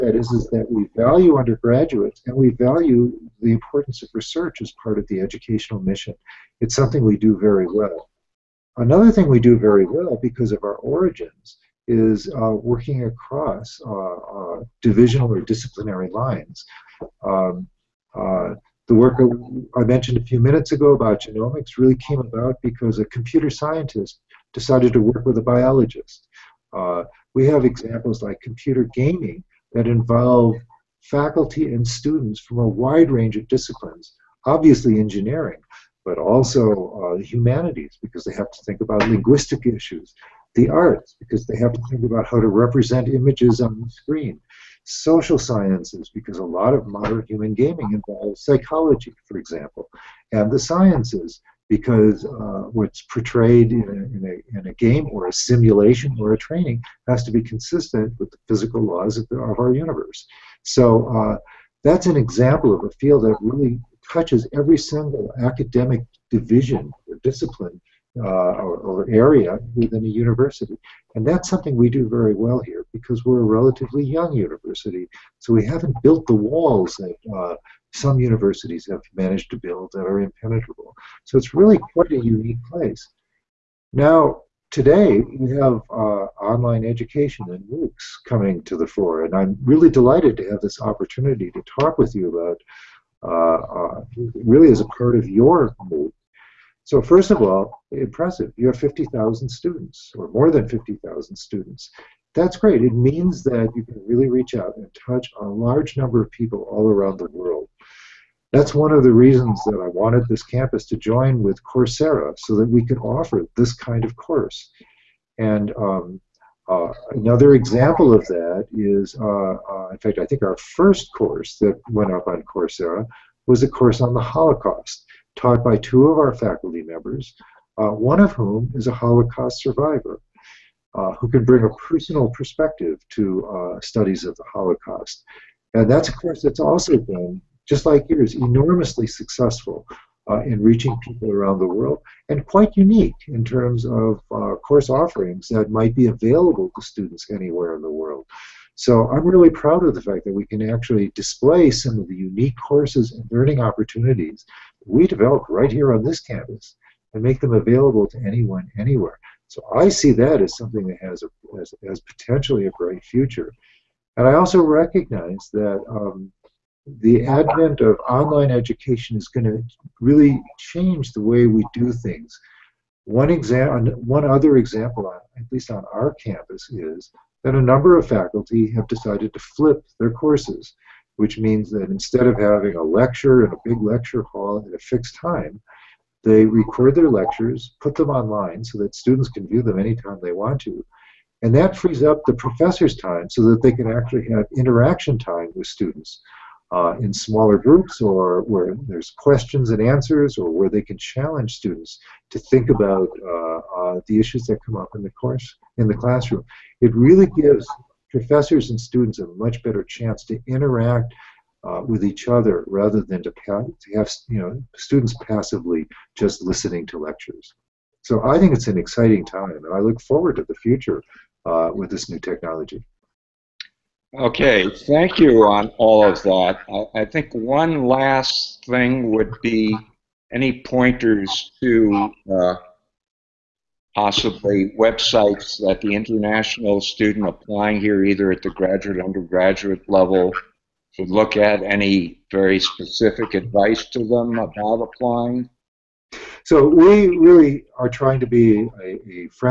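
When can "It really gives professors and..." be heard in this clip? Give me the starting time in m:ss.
3:26.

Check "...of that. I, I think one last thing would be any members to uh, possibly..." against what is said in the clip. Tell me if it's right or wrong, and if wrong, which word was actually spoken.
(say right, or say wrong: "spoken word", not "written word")
wrong: "pointers", not "members".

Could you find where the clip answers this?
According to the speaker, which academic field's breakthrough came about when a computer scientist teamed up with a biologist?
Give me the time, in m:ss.
0:21.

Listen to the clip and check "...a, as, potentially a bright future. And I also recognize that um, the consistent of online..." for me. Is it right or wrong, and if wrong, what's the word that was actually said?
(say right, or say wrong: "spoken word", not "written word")
wrong: "advent", not "consistent".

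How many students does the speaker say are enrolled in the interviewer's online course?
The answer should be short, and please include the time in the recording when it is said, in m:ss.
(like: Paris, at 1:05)
more than 50,000, at 1:40.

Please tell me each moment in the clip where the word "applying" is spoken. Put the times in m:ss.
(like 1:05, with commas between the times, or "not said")
3:57, 4:04.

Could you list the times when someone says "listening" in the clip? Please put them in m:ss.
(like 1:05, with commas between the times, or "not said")
3:36.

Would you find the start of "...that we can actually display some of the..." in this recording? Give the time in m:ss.
2:30.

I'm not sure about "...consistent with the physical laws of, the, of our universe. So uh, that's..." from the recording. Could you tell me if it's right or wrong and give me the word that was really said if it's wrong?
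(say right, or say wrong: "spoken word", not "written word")
right.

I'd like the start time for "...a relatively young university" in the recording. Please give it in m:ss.
1:13.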